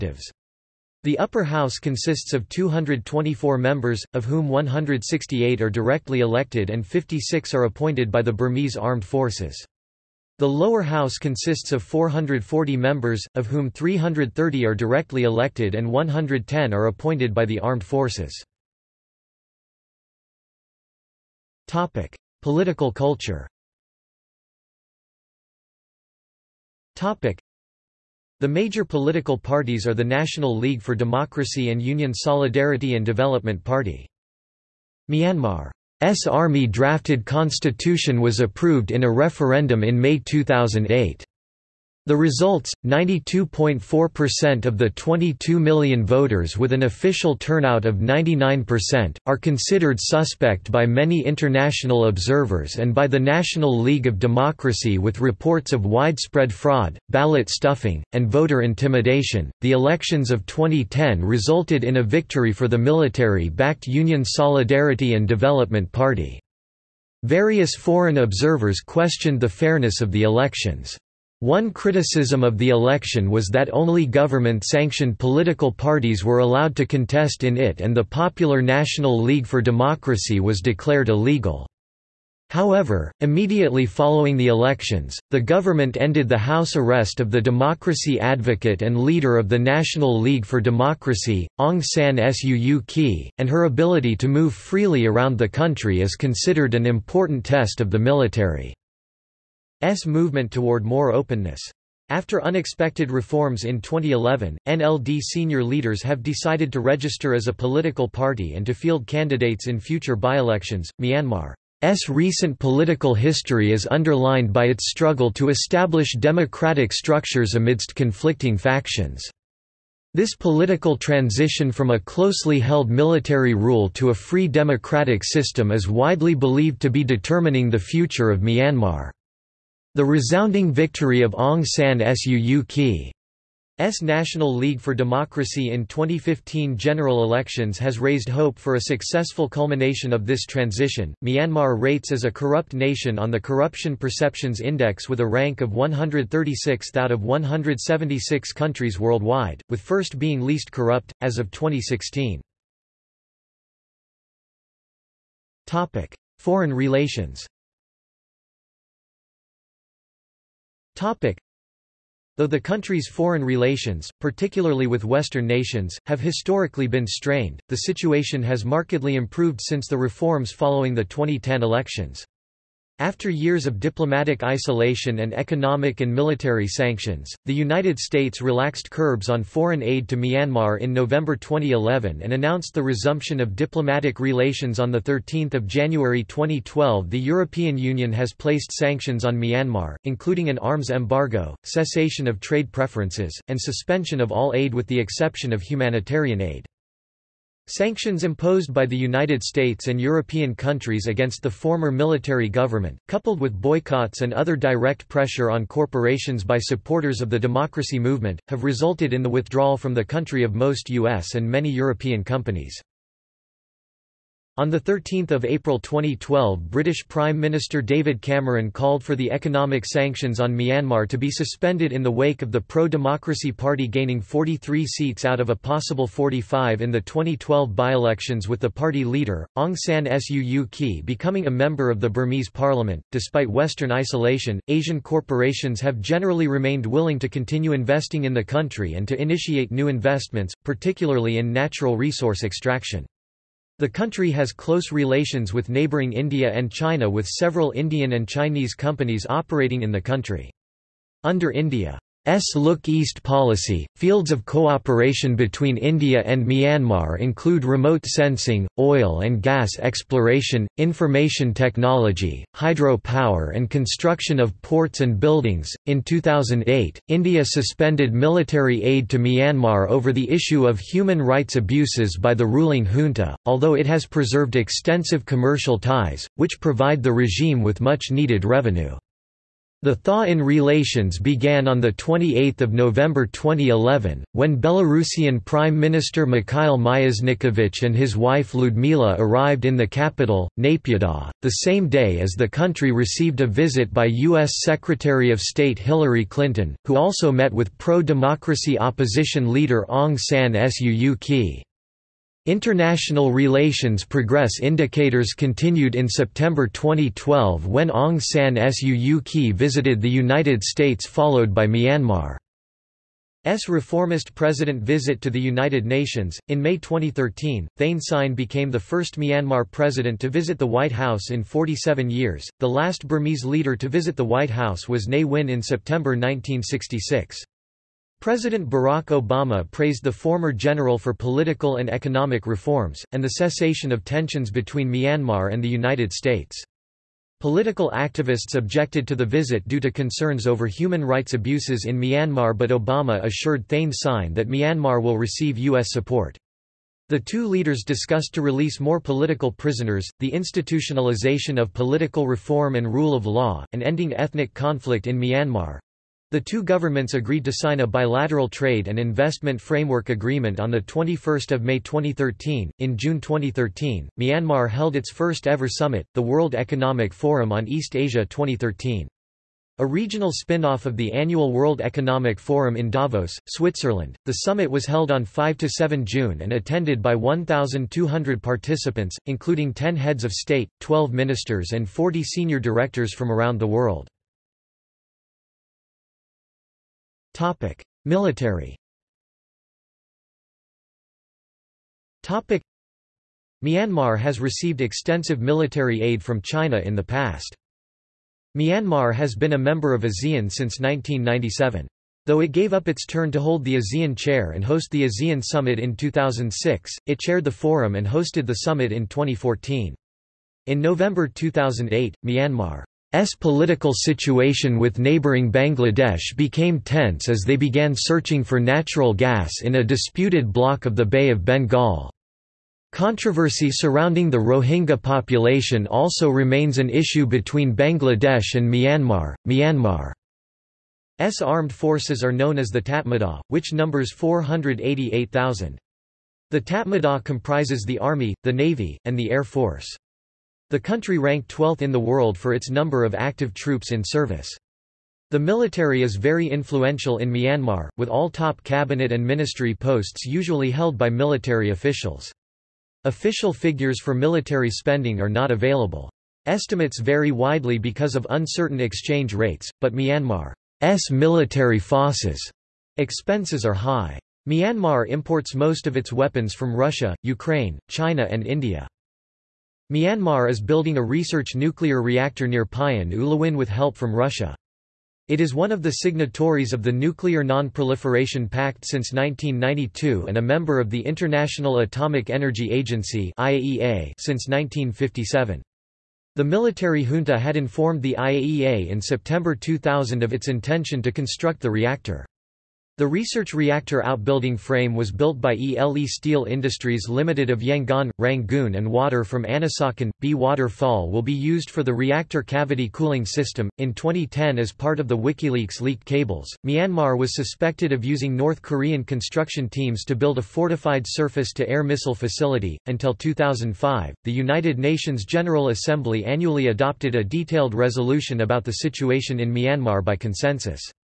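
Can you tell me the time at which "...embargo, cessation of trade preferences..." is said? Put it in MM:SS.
03:10.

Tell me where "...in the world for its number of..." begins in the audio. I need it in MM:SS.
07:21.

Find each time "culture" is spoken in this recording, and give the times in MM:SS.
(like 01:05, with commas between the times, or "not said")
00:22.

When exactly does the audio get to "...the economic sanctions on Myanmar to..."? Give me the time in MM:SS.
03:39.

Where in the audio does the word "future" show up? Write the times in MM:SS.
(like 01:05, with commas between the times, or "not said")
01:49, 02:07.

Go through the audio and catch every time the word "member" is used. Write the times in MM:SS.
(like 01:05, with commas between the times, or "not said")
00:03, 00:12, 03:51, 06:39, 08:00.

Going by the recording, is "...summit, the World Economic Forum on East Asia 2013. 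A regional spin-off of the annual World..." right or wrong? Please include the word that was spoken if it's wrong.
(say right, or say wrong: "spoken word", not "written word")
right.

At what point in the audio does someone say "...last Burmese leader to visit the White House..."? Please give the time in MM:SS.
05:22.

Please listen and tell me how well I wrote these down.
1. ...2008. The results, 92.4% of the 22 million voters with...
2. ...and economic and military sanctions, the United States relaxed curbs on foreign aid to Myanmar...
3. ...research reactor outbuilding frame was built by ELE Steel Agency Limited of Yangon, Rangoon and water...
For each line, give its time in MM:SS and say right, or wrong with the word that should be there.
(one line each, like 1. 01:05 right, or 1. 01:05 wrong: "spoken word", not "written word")
1. 00:40 right
2. 02:55 right
3. 08:13 wrong: "Industries", not "Agency".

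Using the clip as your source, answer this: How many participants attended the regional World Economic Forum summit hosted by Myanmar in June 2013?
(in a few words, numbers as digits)
1,200.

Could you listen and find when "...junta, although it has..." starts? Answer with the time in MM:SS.
04:32.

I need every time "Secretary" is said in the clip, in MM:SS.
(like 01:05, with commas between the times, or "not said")
04:54.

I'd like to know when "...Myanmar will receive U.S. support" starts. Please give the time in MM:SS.
05:44.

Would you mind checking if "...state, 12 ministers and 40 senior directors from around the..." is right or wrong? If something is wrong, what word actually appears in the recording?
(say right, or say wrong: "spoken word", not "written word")
right.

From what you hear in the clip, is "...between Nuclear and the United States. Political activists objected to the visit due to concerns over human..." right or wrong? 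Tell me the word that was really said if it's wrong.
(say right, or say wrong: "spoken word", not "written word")
wrong: "Myanmar", not "Nuclear".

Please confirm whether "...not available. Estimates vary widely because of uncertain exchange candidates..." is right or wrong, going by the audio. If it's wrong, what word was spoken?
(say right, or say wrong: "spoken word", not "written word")
wrong: "rates", not "candidates".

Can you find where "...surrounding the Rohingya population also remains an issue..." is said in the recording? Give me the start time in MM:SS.
07:03.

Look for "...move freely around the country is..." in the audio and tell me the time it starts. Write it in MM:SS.
01:34.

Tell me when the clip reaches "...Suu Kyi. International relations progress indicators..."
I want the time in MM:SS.
05:00.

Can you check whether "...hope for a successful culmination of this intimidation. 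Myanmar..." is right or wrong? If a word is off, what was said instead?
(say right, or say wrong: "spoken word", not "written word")
wrong: "transition", not "intimidation".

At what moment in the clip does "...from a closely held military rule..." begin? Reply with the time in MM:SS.
02:01.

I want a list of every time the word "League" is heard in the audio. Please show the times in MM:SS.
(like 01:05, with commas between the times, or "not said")
00:30, 00:53, 01:19, 01:30, 02:14.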